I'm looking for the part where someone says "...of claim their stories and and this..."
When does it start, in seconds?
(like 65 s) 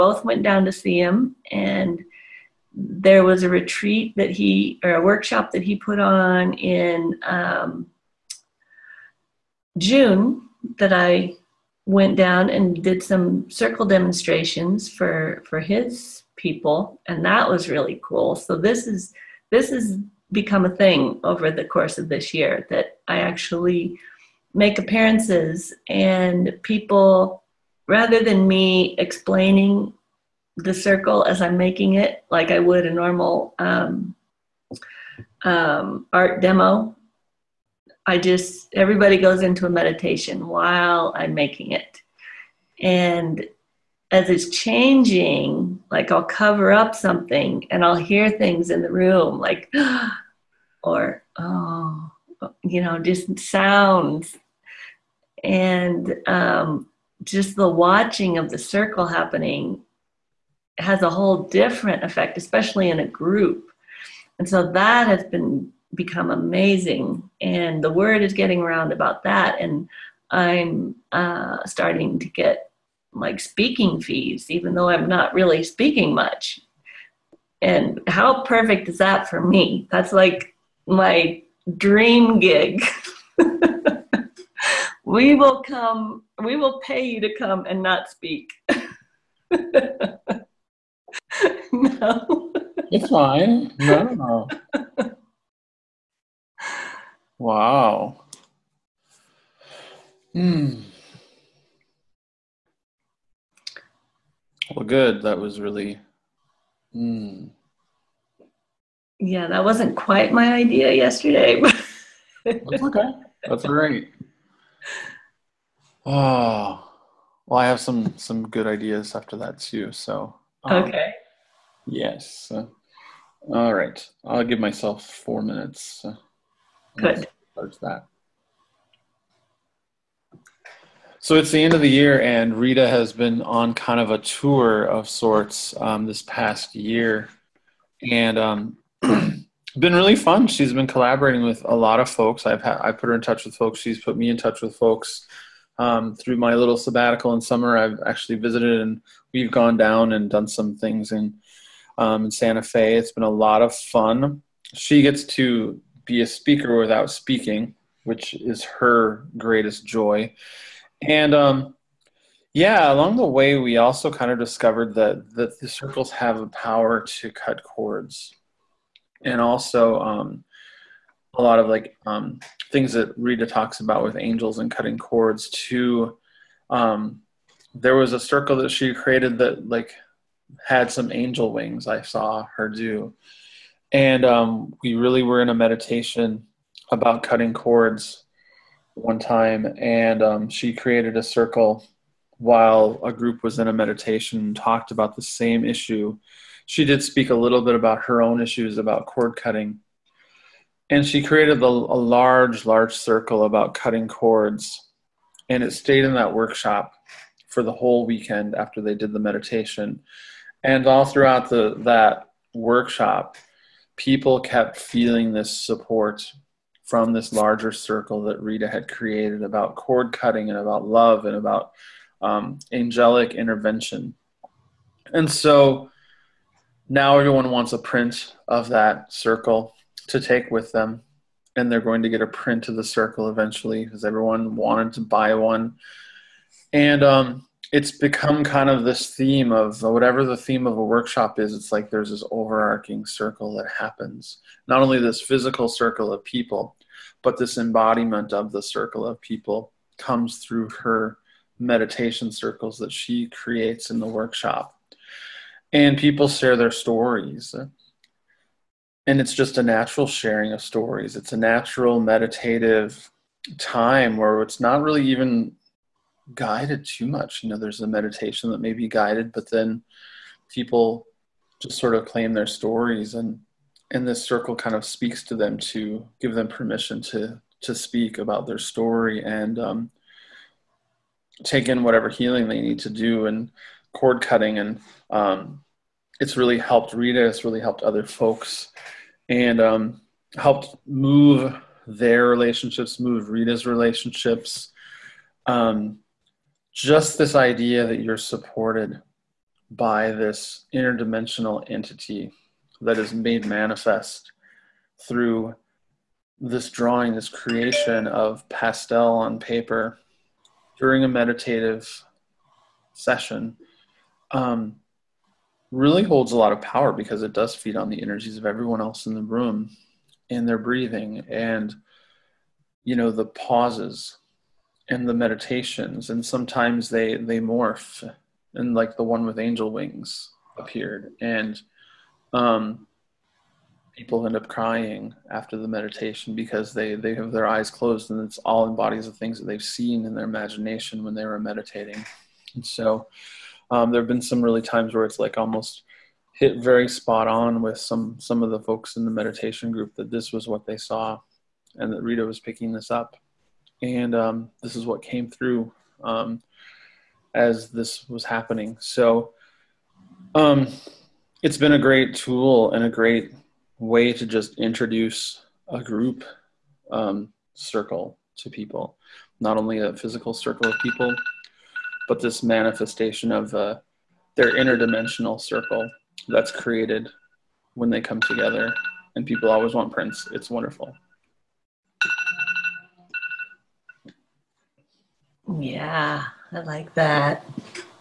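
271 s.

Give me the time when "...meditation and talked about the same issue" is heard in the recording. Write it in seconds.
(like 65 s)
193 s.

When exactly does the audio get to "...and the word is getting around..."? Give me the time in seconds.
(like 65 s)
67 s.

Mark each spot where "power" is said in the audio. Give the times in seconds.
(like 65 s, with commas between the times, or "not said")
166 s, 316 s.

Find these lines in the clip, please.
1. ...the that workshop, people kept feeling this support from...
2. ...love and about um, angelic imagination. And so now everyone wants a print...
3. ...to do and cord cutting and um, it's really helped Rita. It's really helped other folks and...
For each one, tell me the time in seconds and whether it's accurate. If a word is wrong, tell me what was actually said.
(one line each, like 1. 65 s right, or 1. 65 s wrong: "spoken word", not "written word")
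1. 211 s right
2. 220 s wrong: "intervention", not "imagination"
3. 282 s right.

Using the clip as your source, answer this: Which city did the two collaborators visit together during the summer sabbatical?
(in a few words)
Santa Fe.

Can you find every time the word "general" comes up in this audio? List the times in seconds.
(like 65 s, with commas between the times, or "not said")
not said.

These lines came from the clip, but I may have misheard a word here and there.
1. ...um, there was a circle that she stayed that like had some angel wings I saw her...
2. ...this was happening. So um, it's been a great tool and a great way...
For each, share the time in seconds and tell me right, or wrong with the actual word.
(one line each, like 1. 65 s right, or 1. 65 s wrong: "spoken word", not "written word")
1. 176 s wrong: "created", not "stayed"
2. 357 s right.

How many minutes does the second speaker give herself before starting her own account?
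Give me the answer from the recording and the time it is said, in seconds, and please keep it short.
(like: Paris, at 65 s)
4, at 125 s.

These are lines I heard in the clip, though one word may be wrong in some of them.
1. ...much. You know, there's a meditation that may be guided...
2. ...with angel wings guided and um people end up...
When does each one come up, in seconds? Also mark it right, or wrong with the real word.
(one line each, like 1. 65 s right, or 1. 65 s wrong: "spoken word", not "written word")
1. 267 s right
2. 329 s wrong: "appeared", not "guided".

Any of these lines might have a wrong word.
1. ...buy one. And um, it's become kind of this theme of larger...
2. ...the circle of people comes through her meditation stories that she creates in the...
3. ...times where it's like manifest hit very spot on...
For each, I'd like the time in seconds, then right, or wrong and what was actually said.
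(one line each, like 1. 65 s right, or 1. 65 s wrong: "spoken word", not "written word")
1. 235 s wrong: "whatever", not "larger"
2. 248 s wrong: "circles", not "stories"
3. 344 s wrong: "almost", not "manifest".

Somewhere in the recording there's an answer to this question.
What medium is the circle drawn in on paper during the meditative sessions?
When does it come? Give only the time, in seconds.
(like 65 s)
308 s.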